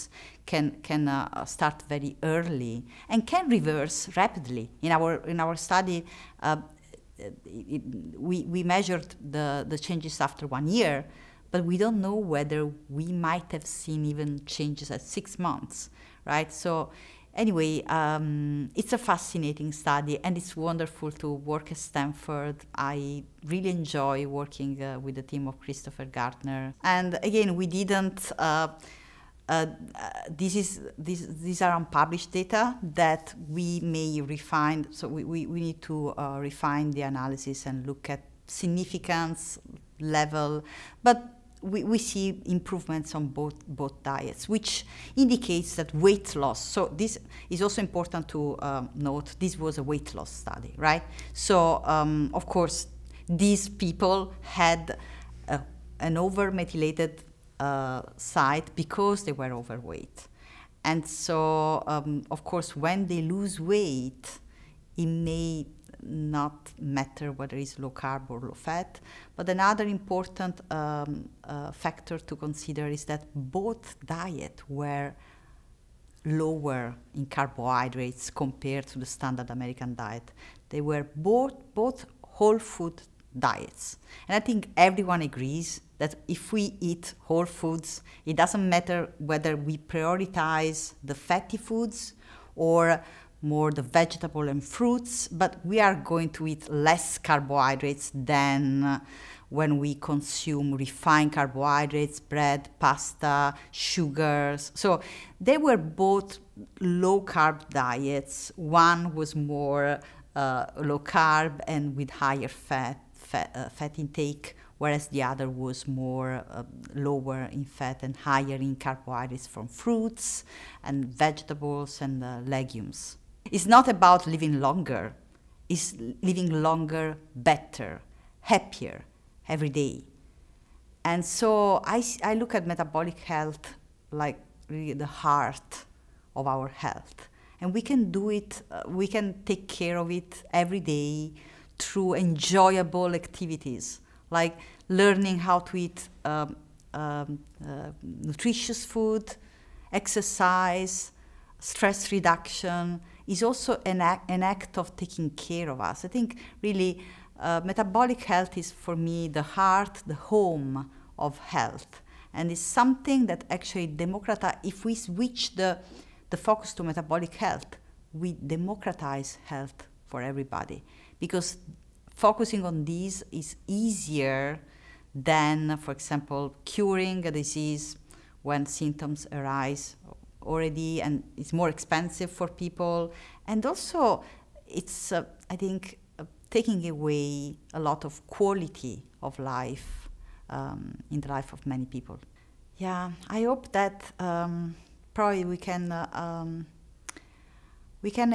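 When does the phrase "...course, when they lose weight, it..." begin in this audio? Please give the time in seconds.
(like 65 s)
62 s.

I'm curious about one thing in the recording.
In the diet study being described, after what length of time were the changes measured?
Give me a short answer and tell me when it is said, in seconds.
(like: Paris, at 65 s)
1 year, at 10 s.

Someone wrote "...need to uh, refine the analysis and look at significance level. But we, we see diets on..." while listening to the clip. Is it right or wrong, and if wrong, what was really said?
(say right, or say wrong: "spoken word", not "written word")
wrong: "improvements", not "diets".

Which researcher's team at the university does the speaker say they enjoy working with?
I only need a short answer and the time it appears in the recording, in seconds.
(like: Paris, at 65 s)
Christopher Gardner, at 25 s.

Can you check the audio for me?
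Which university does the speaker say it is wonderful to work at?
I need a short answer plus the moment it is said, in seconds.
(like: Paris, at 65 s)
Stanford, at 21 s.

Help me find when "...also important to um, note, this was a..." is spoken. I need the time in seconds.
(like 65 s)
47 s.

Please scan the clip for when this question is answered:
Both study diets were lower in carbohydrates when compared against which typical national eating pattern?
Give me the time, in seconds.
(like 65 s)
79 s.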